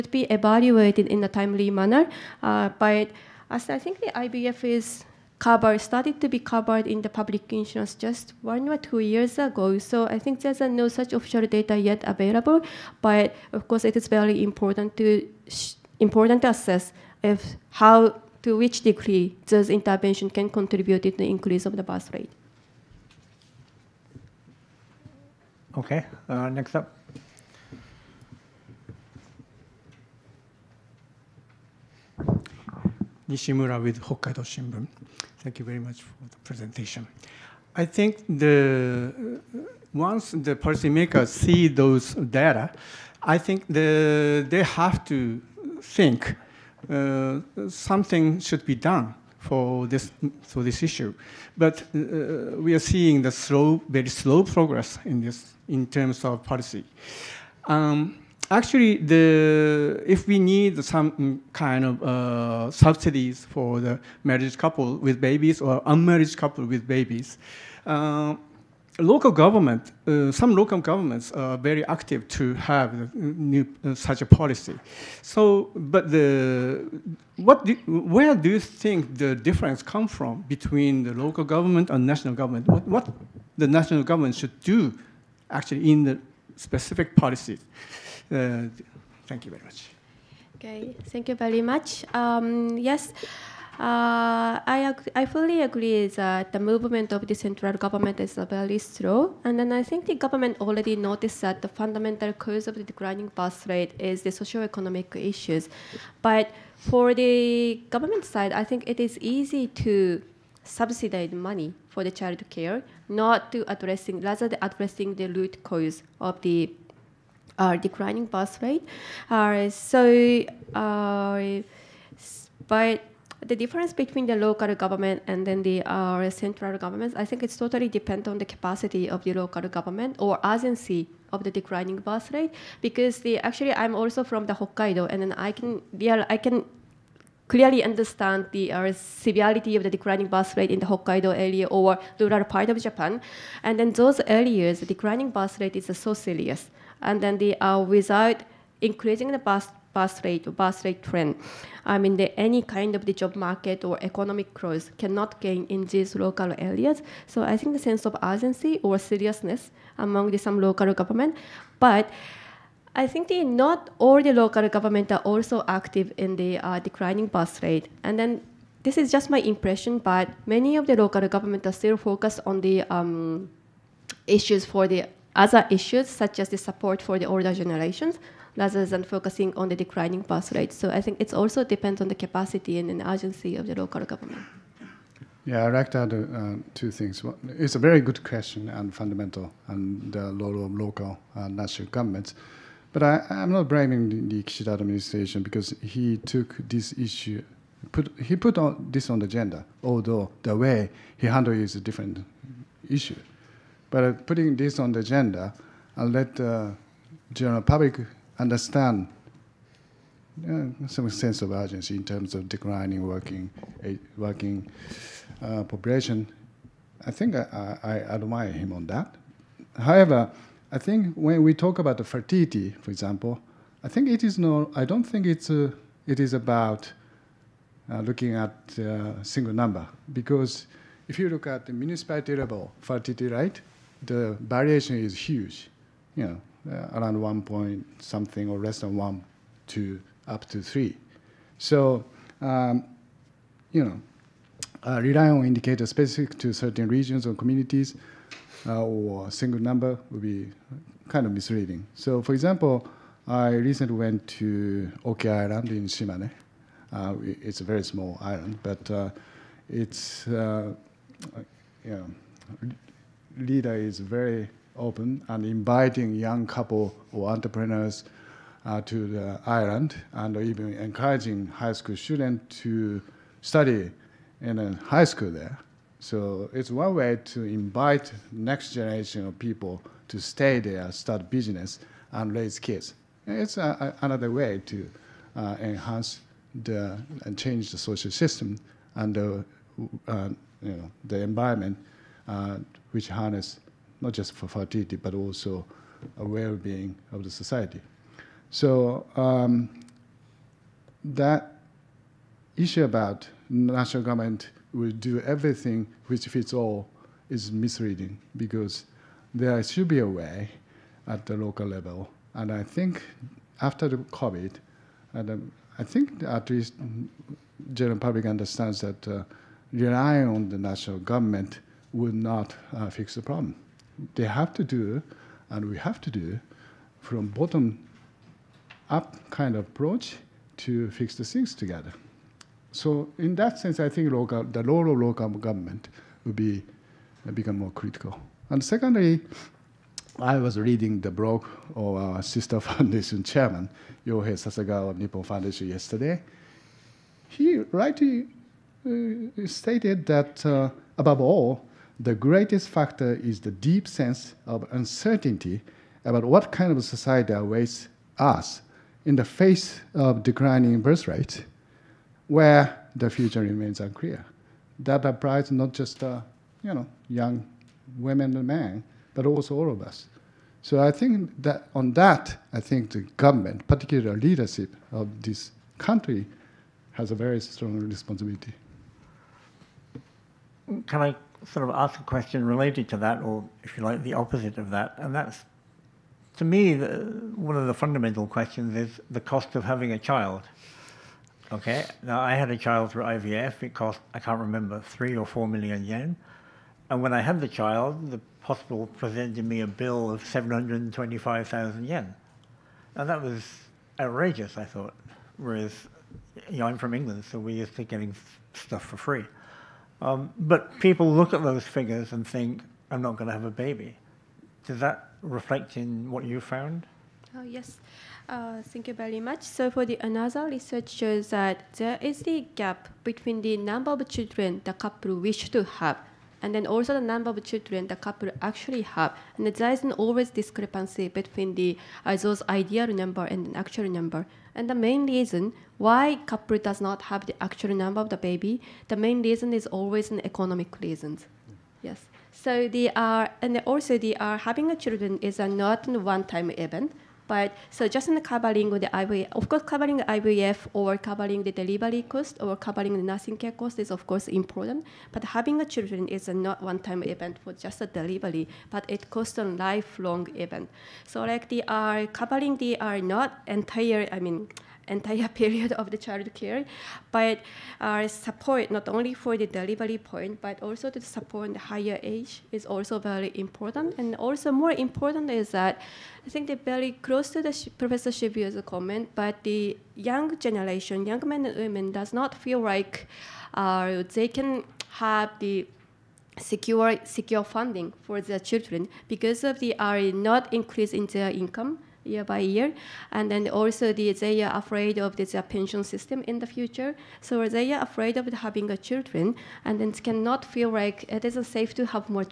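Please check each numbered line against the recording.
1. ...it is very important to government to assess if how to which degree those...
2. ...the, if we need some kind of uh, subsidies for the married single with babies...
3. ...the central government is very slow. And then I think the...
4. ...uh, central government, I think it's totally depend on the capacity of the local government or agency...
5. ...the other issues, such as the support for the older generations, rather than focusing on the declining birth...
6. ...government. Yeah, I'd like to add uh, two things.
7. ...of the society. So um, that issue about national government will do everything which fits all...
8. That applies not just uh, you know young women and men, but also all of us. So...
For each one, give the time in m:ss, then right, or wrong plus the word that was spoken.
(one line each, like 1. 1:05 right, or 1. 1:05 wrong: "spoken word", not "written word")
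1. 0:13 wrong: "important", not "government"
2. 0:58 wrong: "couple", not "single"
3. 1:37 right
4. 2:05 right
5. 2:54 right
6. 3:04 right
7. 4:57 right
8. 6:04 right.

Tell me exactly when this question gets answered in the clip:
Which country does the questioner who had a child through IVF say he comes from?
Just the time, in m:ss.
6:46.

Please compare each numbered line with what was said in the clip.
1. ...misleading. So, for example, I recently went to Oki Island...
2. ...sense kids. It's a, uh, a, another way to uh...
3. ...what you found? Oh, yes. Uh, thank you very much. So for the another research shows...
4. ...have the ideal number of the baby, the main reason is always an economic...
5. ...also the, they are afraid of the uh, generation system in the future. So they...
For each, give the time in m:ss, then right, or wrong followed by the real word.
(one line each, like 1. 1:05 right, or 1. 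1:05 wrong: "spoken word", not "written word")
1. 4:11 right
2. 4:42 wrong: "raise", not "sense"
3. 6:56 right
4. 7:17 wrong: "actual", not "ideal"
5. 8:13 wrong: "pension", not "generation".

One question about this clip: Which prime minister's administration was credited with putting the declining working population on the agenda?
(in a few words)
Kishida.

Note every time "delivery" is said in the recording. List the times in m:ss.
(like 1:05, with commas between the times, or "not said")
7:31, 7:37, 7:49.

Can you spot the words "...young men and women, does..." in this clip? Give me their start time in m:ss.
8:01.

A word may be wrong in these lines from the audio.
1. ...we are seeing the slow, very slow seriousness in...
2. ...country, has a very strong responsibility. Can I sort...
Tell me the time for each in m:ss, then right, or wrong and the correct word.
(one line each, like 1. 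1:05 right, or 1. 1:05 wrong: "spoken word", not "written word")
1. 0:52 wrong: "progress", not "seriousness"
2. 6:15 right.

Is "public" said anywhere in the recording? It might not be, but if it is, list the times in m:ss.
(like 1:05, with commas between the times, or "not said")
0:07, 3:27, 5:17.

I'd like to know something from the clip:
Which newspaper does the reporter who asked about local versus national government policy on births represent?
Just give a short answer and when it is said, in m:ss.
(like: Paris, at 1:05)
Hokkaido Shimbun, at 0:34.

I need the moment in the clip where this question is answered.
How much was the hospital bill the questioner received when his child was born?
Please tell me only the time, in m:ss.
6:40.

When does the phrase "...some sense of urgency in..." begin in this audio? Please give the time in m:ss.
3:30.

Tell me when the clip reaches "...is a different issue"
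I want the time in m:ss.
3:21.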